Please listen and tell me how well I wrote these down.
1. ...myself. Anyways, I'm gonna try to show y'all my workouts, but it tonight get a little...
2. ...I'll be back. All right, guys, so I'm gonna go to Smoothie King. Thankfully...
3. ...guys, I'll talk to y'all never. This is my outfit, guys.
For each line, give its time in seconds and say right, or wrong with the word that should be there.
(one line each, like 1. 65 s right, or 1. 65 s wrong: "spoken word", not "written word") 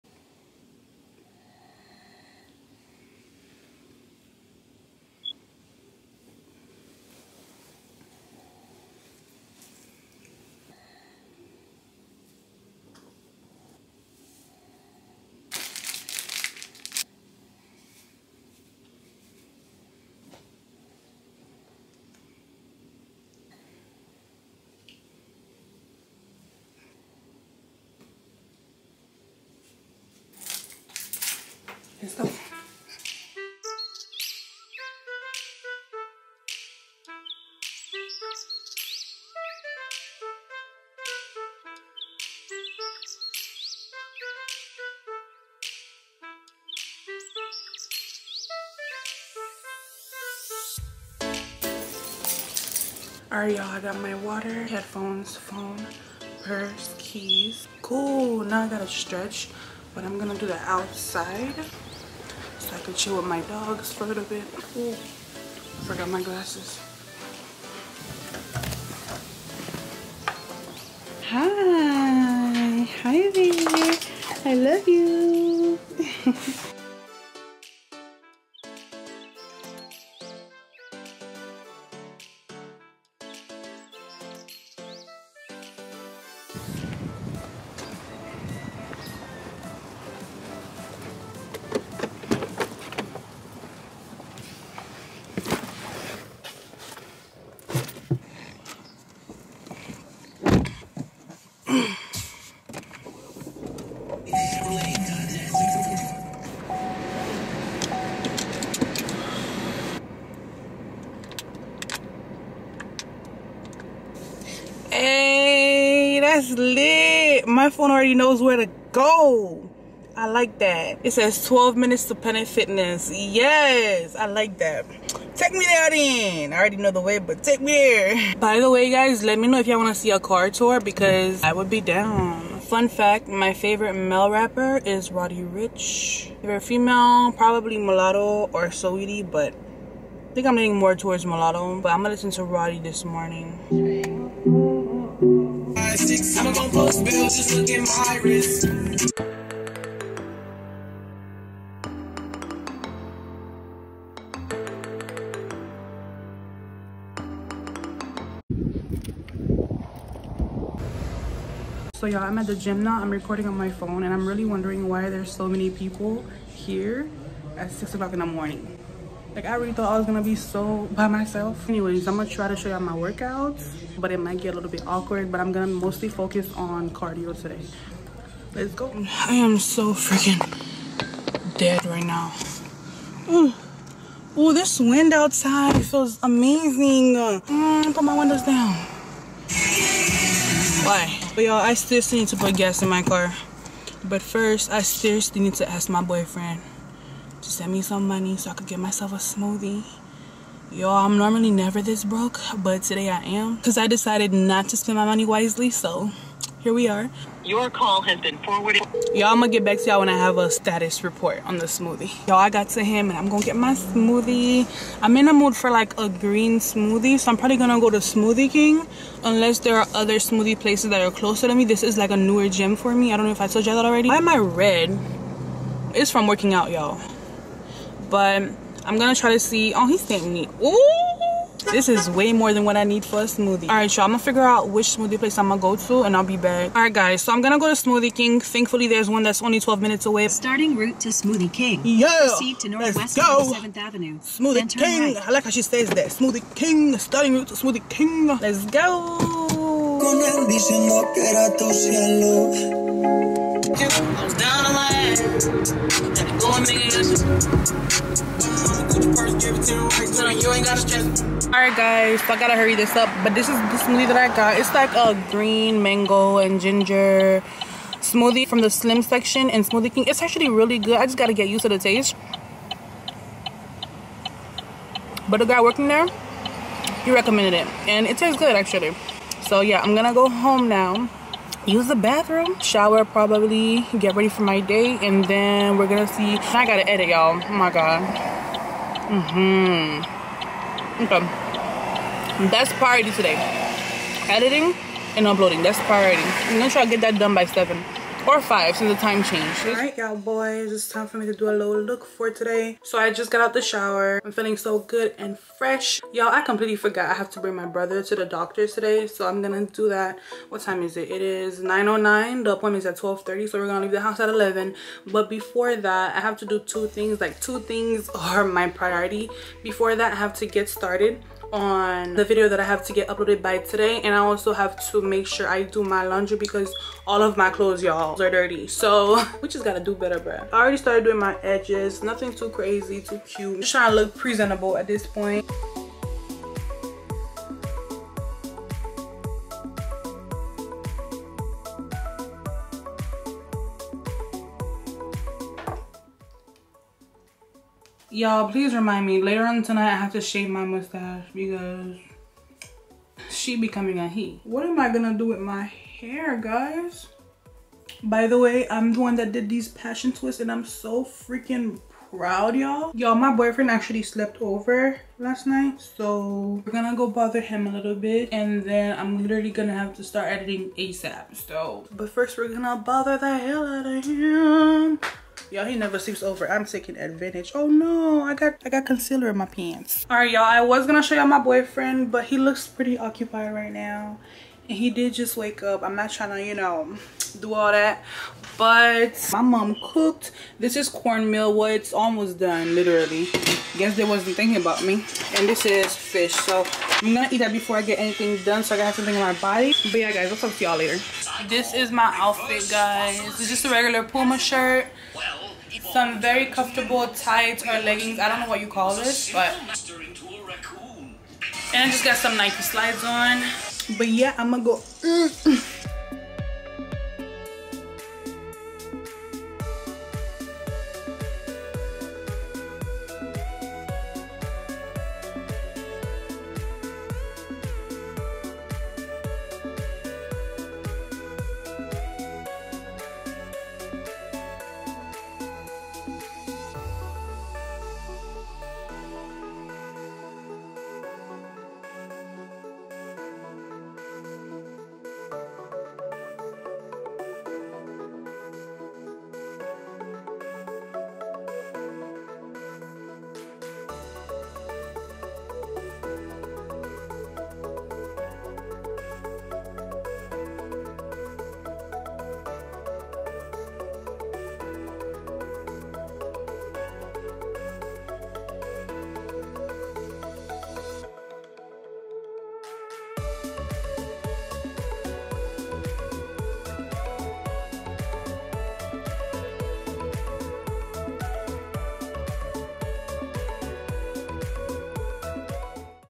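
1. 171 s wrong: "might", not "tonight"
2. 236 s right
3. 400 s wrong: "later", not "never".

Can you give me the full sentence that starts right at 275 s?
But the guy working there, he recommended it.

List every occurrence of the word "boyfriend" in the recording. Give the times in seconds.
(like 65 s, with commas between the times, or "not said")
196 s, 363 s, 381 s.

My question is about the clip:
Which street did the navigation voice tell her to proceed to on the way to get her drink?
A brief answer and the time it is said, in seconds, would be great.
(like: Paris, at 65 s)
Northwest 7th Avenue, at 242 s.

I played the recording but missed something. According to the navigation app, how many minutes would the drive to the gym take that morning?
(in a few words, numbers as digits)
12 minutes.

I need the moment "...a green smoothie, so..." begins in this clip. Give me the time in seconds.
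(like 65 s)
215 s.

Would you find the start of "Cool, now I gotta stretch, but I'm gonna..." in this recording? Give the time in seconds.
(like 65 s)
57 s.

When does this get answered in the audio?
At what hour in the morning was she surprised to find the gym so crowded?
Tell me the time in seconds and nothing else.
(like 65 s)
167 s.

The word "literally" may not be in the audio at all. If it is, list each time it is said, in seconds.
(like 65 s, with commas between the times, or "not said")
369 s, 392 s.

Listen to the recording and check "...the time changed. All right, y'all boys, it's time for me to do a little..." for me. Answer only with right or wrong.
right.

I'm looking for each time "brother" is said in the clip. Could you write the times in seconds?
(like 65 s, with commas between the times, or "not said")
307 s.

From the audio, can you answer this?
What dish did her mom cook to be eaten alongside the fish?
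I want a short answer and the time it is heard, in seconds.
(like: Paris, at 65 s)
Cornmeal, at 390 s.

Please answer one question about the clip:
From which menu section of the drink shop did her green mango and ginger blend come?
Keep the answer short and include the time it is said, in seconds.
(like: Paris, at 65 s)
Slim section, at 268 s.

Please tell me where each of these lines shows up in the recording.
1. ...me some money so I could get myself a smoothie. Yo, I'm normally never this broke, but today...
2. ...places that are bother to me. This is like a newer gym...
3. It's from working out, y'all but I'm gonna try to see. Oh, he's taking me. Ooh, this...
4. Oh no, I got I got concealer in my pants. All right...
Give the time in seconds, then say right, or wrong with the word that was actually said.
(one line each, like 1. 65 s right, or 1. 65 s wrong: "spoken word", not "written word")
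1. 197 s right
2. 220 s wrong: "closer", not "bother"
3. 225 s right
4. 377 s right.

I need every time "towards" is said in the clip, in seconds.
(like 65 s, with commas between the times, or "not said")
140 s.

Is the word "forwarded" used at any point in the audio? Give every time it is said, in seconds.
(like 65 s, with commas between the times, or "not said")
208 s.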